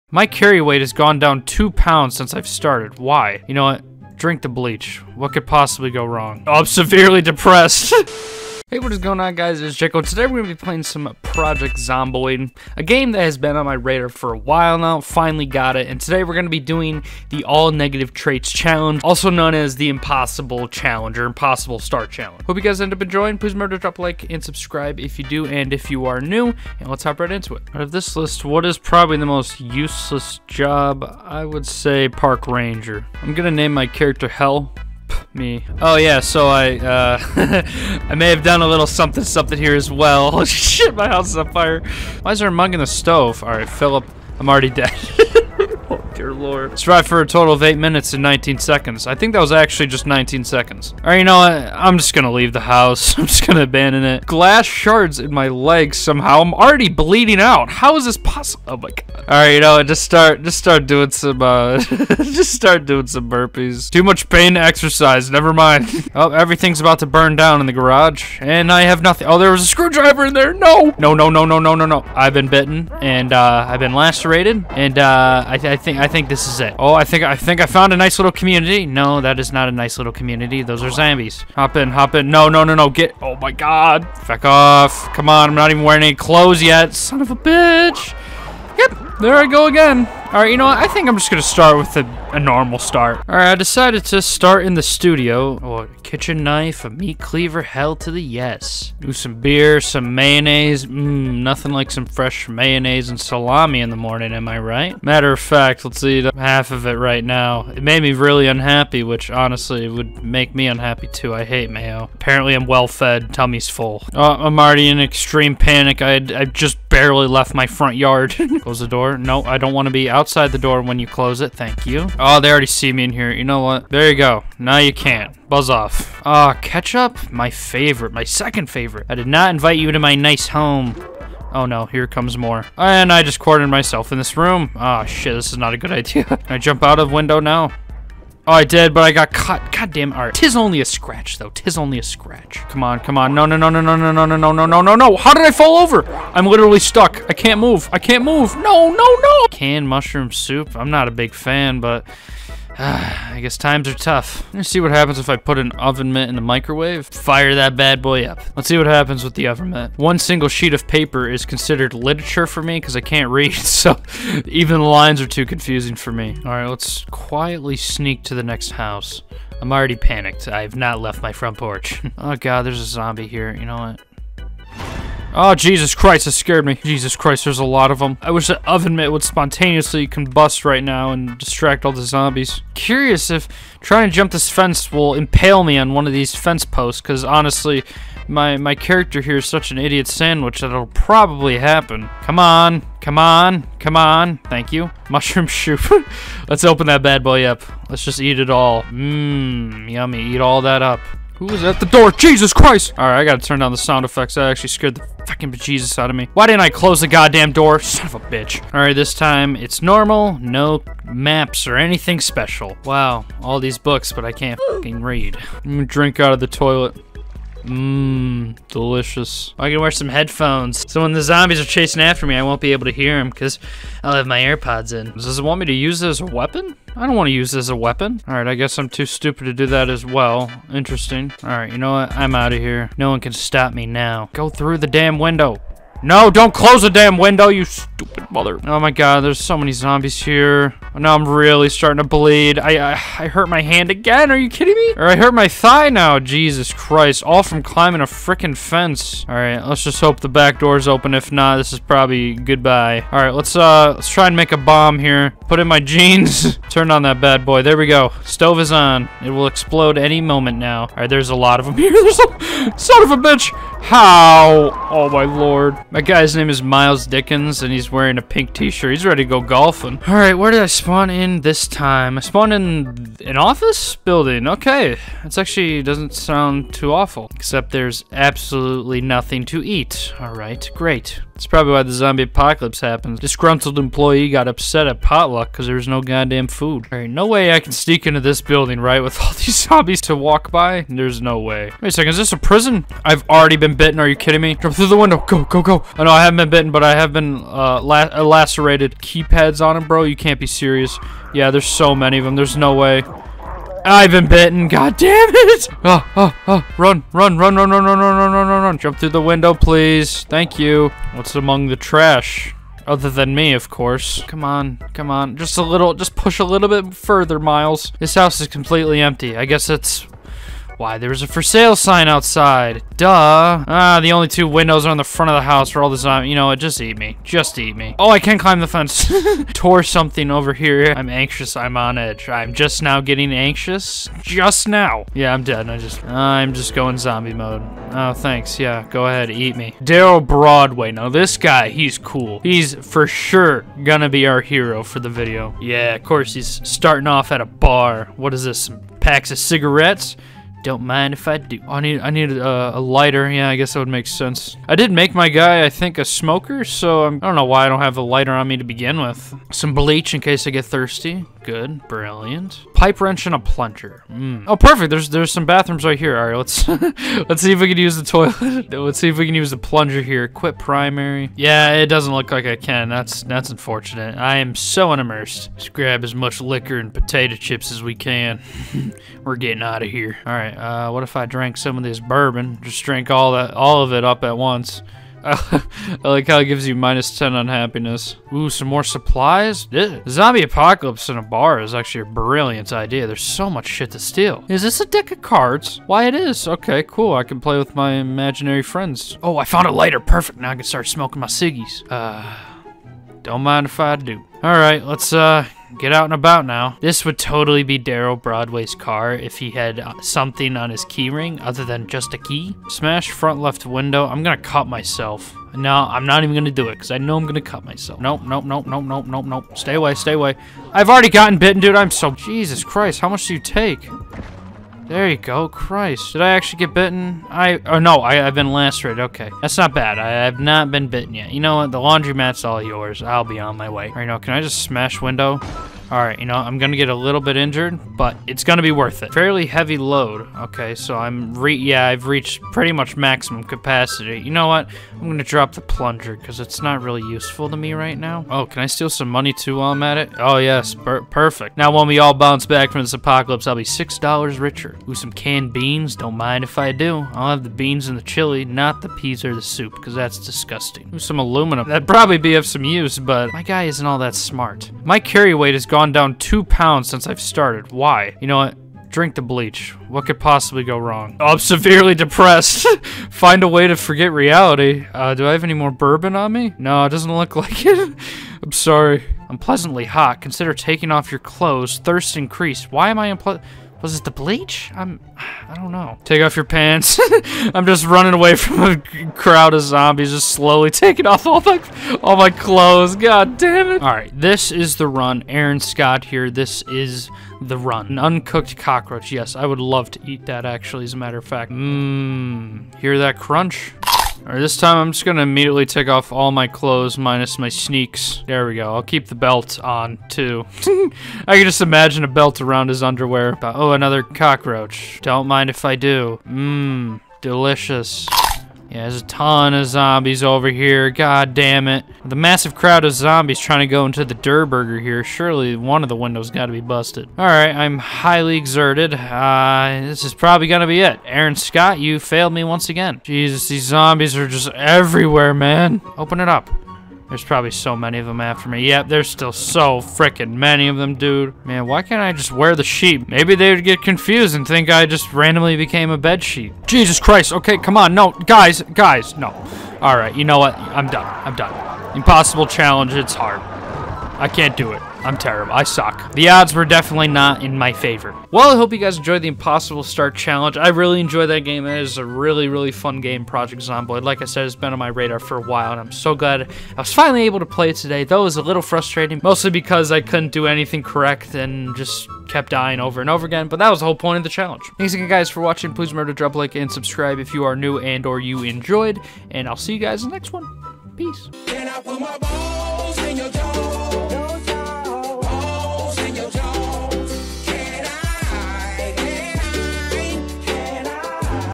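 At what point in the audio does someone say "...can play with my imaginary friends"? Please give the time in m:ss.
6:37.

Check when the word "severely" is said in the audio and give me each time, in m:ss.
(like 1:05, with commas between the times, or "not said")
0:06, 7:51.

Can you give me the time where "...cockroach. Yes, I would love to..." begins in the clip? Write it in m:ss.
8:18.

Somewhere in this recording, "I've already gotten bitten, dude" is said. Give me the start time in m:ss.
7:00.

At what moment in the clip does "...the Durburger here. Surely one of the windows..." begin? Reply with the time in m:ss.
8:44.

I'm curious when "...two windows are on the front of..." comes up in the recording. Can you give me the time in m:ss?
5:24.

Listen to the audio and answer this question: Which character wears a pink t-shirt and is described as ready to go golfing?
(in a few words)
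Miles Dickens.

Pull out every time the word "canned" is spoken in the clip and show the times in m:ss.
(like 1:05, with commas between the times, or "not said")
2:29, 7:35.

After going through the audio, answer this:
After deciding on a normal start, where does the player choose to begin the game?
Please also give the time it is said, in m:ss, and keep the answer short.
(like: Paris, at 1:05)
the studio, at 1:34.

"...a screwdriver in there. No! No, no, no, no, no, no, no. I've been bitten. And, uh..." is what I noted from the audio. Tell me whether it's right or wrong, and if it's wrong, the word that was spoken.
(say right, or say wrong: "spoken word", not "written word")
right.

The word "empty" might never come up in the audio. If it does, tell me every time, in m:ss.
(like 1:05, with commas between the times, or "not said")
5:19.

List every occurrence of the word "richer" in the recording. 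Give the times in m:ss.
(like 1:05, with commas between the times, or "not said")
7:34.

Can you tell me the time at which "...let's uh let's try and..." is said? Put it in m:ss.
4:13.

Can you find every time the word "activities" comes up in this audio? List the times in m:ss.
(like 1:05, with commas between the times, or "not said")
not said.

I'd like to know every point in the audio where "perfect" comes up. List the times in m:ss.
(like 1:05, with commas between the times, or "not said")
6:04, 6:39, 7:31.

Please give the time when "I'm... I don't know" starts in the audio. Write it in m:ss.
8:04.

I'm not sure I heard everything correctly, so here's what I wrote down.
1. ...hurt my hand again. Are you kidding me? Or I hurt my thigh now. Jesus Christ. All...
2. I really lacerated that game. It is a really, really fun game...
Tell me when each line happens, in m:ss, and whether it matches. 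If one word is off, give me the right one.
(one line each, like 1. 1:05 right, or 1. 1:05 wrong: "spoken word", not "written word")
1. 4:03 right
2. 9:20 wrong: "enjoyed", not "lacerated".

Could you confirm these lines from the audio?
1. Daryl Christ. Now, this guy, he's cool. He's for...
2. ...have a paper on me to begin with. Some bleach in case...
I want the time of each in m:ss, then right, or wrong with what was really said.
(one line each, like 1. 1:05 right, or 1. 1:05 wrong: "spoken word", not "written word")
1. 5:39 wrong: "Broadway", not "Christ"
2. 5:57 wrong: "lighter", not "paper".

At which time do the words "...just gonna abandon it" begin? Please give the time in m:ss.
0:53.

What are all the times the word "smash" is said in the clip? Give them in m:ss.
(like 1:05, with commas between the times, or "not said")
6:52, 7:14.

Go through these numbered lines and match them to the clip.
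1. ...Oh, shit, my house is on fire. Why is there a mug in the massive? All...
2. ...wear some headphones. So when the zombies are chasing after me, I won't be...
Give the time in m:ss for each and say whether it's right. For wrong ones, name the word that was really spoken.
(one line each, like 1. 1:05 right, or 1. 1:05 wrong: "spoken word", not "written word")
1. 0:40 wrong: "stove", not "massive"
2. 3:39 right.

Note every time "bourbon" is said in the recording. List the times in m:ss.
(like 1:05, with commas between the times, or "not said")
6:21, 7:55.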